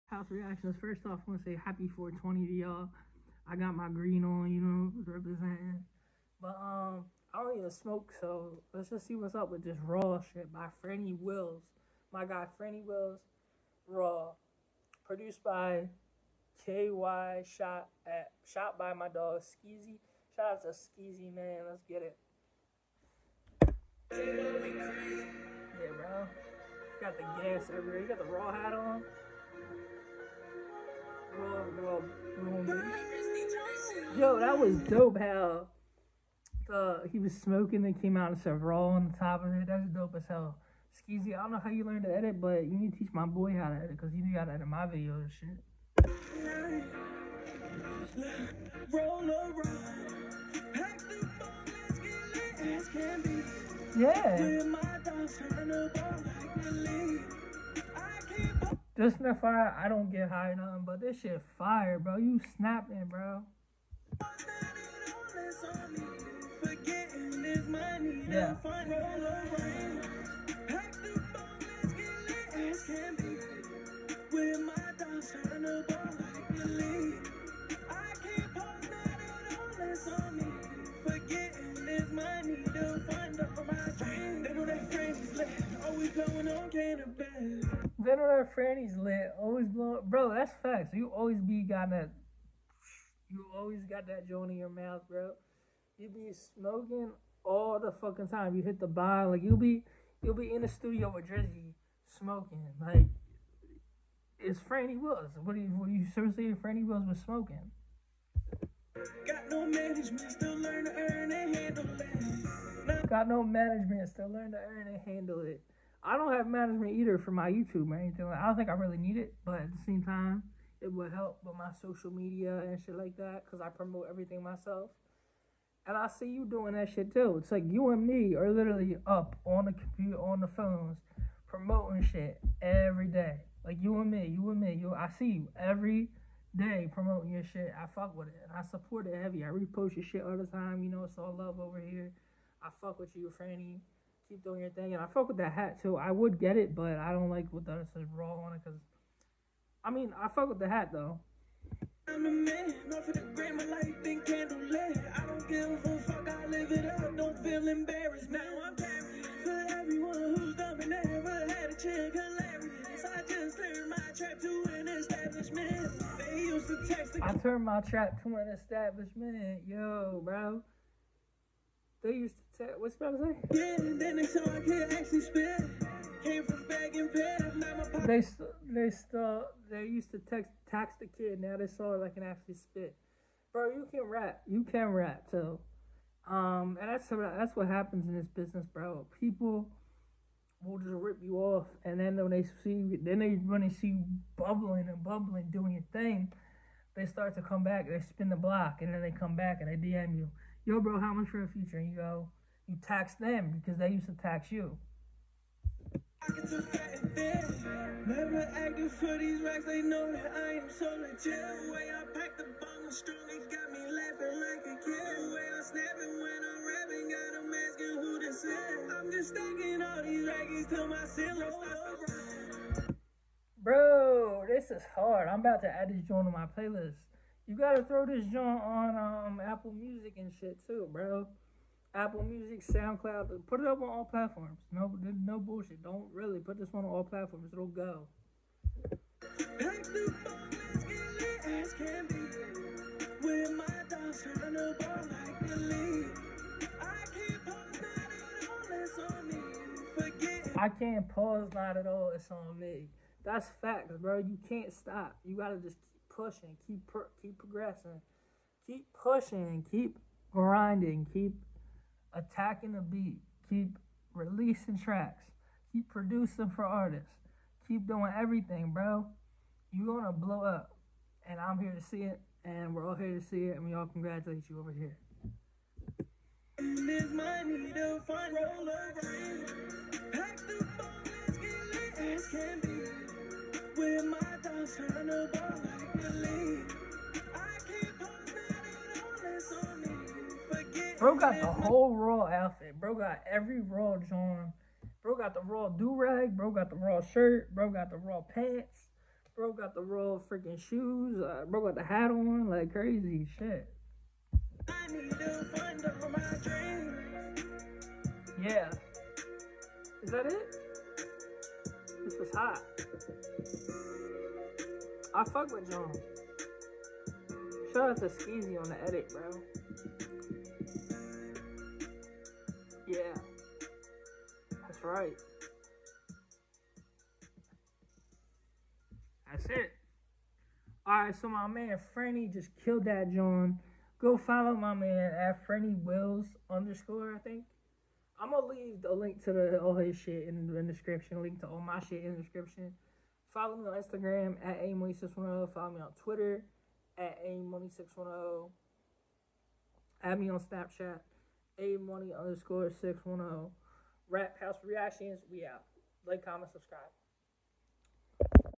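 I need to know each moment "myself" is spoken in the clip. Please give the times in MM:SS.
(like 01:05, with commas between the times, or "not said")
02:04.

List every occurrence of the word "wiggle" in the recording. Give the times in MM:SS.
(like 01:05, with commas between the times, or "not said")
not said.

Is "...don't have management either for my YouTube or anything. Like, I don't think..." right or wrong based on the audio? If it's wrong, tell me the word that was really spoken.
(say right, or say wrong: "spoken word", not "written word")
right.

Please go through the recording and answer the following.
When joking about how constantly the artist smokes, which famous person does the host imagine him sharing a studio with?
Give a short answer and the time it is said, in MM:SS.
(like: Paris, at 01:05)
Drizzy, at 01:41.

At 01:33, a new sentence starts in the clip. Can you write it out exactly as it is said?
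You always got that joint in your mouth, bro.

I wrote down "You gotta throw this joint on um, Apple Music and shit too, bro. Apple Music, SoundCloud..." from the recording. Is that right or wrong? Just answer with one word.
right.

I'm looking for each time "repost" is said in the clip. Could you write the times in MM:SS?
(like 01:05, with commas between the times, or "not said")
02:19.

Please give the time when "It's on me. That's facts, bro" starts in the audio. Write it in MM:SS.
04:12.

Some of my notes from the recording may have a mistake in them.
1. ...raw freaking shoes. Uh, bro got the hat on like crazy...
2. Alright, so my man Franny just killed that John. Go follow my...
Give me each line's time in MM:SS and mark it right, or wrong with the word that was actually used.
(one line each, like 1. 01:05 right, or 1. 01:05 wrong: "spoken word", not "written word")
1. 04:59 right
2. 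05:30 right.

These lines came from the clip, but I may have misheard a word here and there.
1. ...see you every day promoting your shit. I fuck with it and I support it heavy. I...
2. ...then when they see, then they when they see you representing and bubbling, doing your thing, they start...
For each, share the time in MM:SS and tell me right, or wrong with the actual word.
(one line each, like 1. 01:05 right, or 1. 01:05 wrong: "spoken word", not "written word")
1. 02:15 right
2. 03:11 wrong: "bubbling", not "representing".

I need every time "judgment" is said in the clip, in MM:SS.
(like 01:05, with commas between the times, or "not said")
not said.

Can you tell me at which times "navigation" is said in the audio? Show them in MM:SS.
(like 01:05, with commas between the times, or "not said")
not said.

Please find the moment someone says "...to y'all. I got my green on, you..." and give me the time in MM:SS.
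00:02.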